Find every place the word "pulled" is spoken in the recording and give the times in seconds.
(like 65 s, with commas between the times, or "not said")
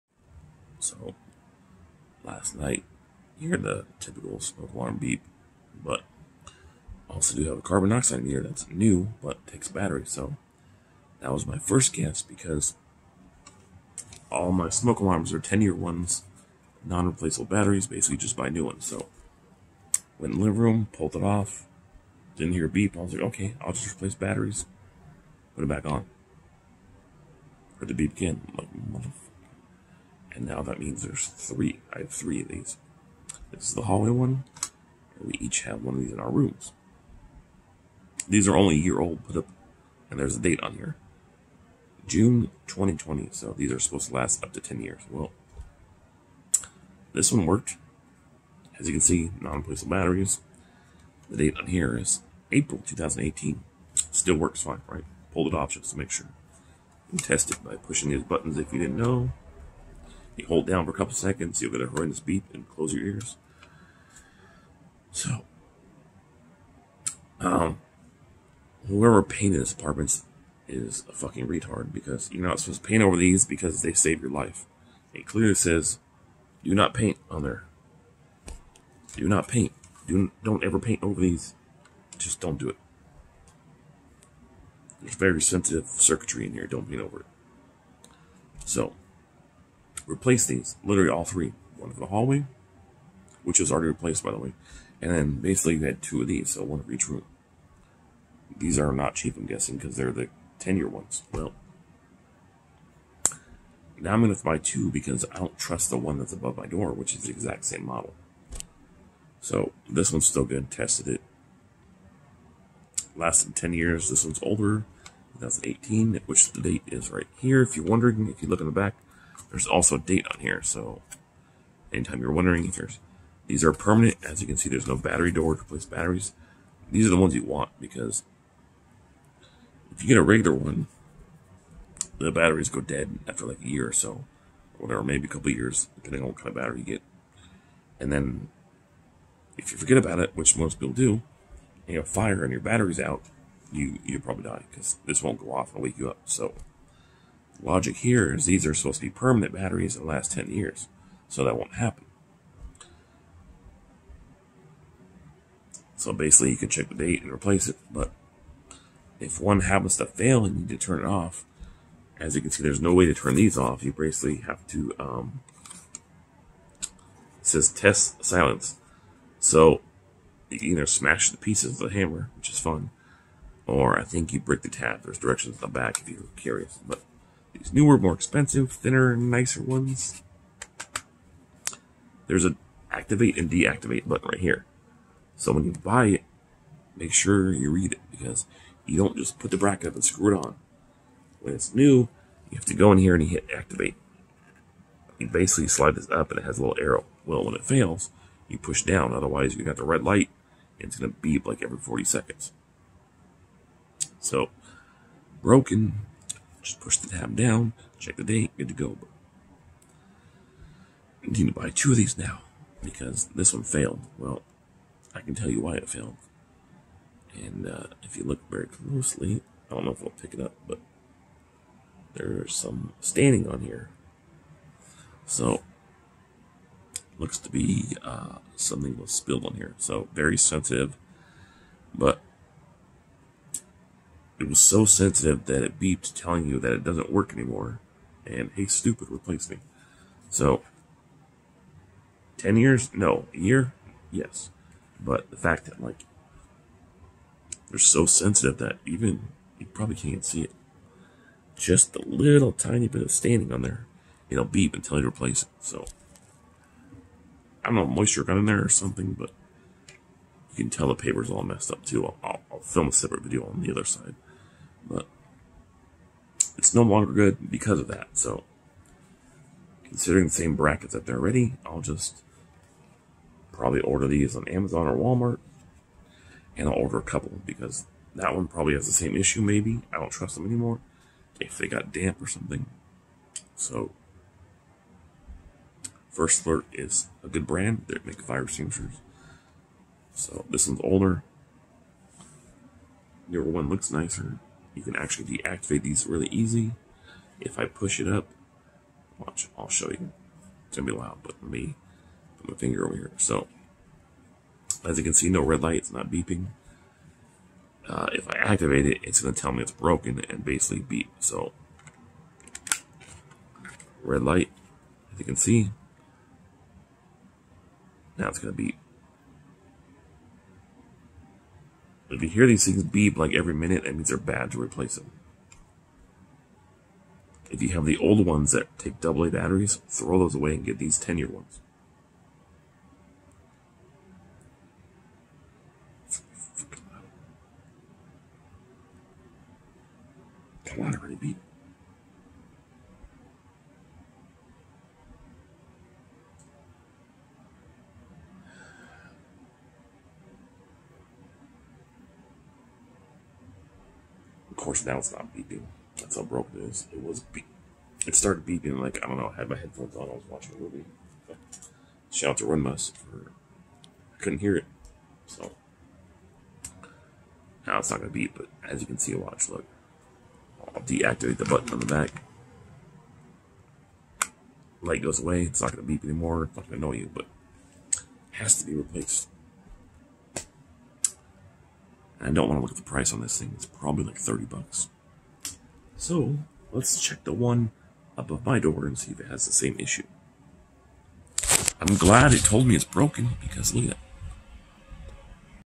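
20 s, 55 s.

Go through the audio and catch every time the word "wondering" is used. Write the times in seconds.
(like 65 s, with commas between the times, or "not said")
117 s, 122 s.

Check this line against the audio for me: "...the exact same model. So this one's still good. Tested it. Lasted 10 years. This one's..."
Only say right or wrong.
right.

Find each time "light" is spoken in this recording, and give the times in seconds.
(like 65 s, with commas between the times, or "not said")
200 s, 305 s, 314 s, 374 s.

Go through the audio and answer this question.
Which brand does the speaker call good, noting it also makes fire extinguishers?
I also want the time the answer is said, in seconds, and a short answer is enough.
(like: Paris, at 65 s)
First Alert, at 286 s.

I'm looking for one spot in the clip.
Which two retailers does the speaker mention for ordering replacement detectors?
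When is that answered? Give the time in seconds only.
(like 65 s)
274 s.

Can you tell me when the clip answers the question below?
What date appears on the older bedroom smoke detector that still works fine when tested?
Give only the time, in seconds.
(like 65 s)
52 s.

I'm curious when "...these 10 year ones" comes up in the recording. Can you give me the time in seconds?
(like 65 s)
330 s.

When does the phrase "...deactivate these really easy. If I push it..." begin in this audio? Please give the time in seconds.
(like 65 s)
295 s.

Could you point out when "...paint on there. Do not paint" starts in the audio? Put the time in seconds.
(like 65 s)
76 s.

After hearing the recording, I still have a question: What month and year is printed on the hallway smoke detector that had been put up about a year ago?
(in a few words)
June 2020.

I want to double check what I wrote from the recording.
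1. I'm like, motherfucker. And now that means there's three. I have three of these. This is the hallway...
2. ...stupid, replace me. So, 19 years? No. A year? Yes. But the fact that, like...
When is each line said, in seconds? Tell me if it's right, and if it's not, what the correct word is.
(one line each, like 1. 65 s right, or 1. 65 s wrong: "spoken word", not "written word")
1. 28 s right
2. 238 s wrong: "10", not "19".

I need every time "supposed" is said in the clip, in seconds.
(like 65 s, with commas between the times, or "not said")
43 s, 72 s, 148 s.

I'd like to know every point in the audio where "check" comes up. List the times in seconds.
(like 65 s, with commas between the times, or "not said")
156 s, 207 s, 387 s.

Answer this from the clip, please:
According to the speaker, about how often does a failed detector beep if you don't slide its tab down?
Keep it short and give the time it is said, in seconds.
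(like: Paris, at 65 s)
every 40 seconds, at 201 s.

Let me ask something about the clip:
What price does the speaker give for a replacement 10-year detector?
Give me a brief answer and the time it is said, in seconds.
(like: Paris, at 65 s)
$30, at 384 s.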